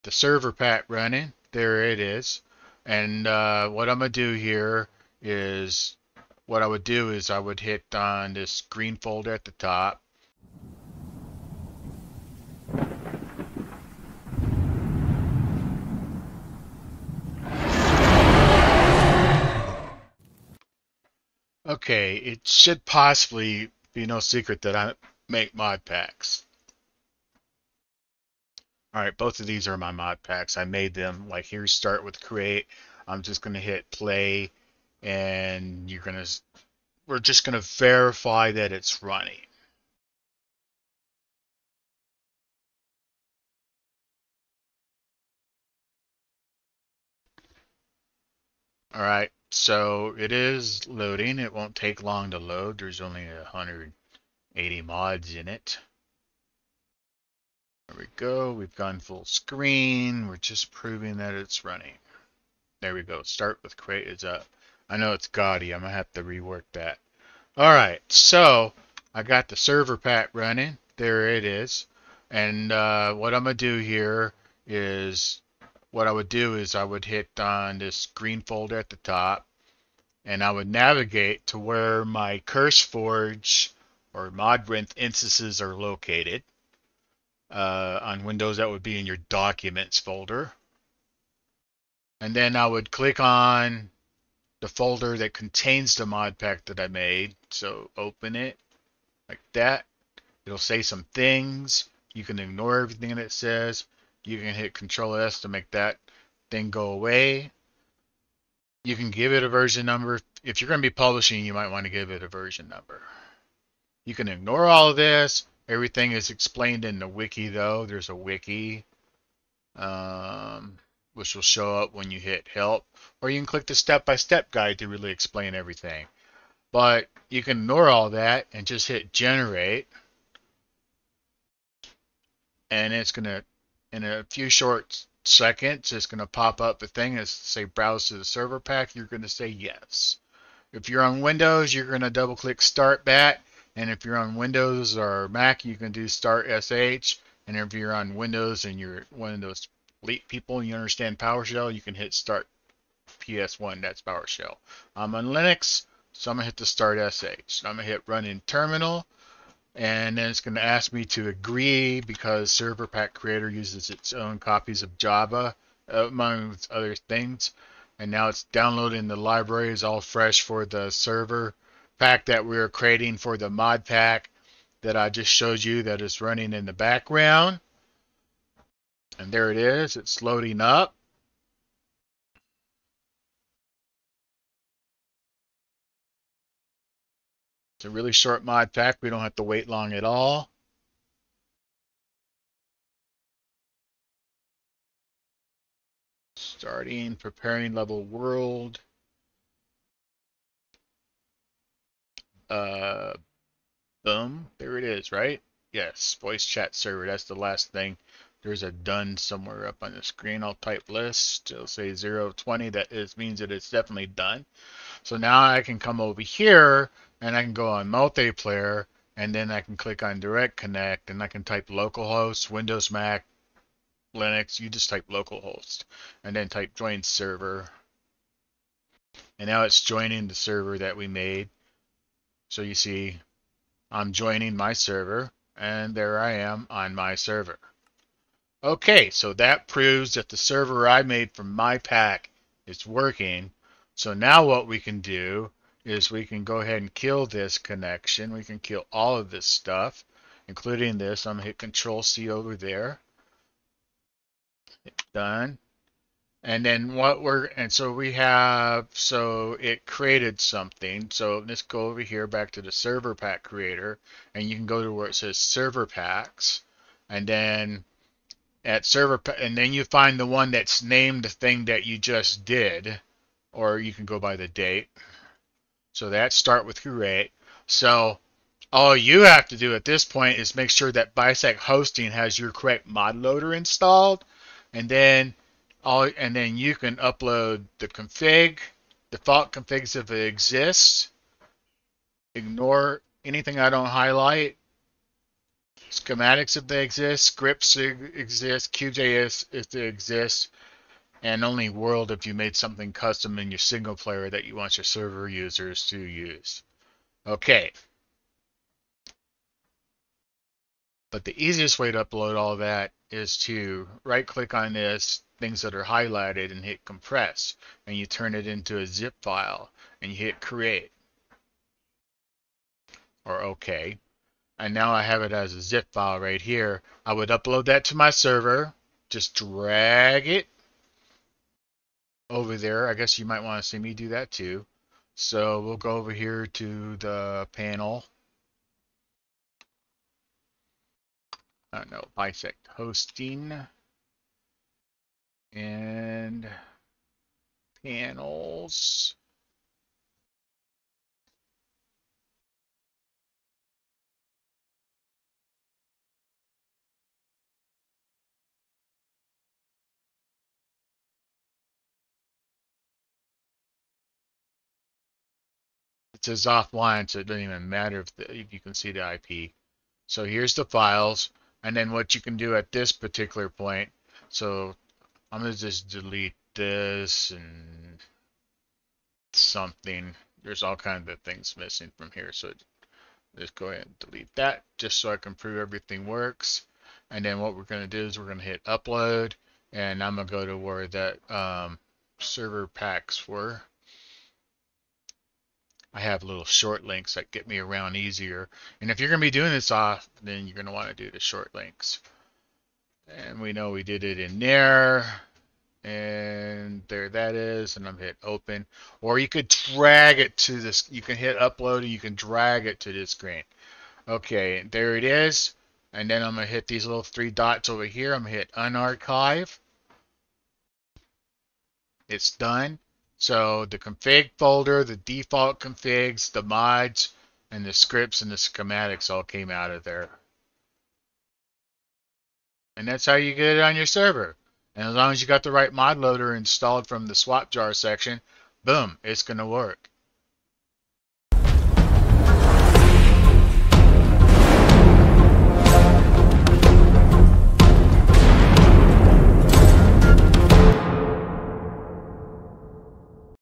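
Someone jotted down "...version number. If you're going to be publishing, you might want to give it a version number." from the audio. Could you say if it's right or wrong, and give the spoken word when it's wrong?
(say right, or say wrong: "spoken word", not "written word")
right.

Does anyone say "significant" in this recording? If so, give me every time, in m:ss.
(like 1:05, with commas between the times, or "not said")
not said.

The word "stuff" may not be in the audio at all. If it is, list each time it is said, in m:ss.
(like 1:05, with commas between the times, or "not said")
4:09.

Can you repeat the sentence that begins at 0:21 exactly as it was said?
Okay, it should possibly be no secret that I make mod packs.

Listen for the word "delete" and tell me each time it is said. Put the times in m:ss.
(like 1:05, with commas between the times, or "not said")
6:15, 6:23.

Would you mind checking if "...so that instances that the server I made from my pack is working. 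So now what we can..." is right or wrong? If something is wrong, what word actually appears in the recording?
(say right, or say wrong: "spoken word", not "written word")
wrong: "proves", not "instances".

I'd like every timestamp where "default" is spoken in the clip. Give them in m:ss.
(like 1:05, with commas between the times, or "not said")
4:49, 7:04.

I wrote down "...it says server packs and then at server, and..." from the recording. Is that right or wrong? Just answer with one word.
right.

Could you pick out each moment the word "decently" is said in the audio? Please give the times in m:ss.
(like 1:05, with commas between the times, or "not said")
not said.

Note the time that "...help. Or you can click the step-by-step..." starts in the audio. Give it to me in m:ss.
2:02.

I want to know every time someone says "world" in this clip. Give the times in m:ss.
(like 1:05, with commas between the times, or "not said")
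3:18, 5:01.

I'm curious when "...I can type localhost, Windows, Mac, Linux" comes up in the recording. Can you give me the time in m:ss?
3:41.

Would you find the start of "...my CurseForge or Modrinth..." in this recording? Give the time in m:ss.
1:22.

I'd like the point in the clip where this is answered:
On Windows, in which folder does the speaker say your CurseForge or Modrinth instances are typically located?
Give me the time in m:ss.
1:29.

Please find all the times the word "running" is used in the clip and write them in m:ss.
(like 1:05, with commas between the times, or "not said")
0:00, 0:39, 1:01, 1:10, 2:56.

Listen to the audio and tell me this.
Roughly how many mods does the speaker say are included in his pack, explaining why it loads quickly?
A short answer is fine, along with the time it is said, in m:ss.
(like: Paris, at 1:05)
180, at 0:53.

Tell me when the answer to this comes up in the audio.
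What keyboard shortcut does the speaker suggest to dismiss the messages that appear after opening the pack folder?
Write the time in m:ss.
1:44.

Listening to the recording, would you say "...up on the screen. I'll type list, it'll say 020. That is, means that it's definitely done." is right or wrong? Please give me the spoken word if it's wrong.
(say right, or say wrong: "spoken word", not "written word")
right.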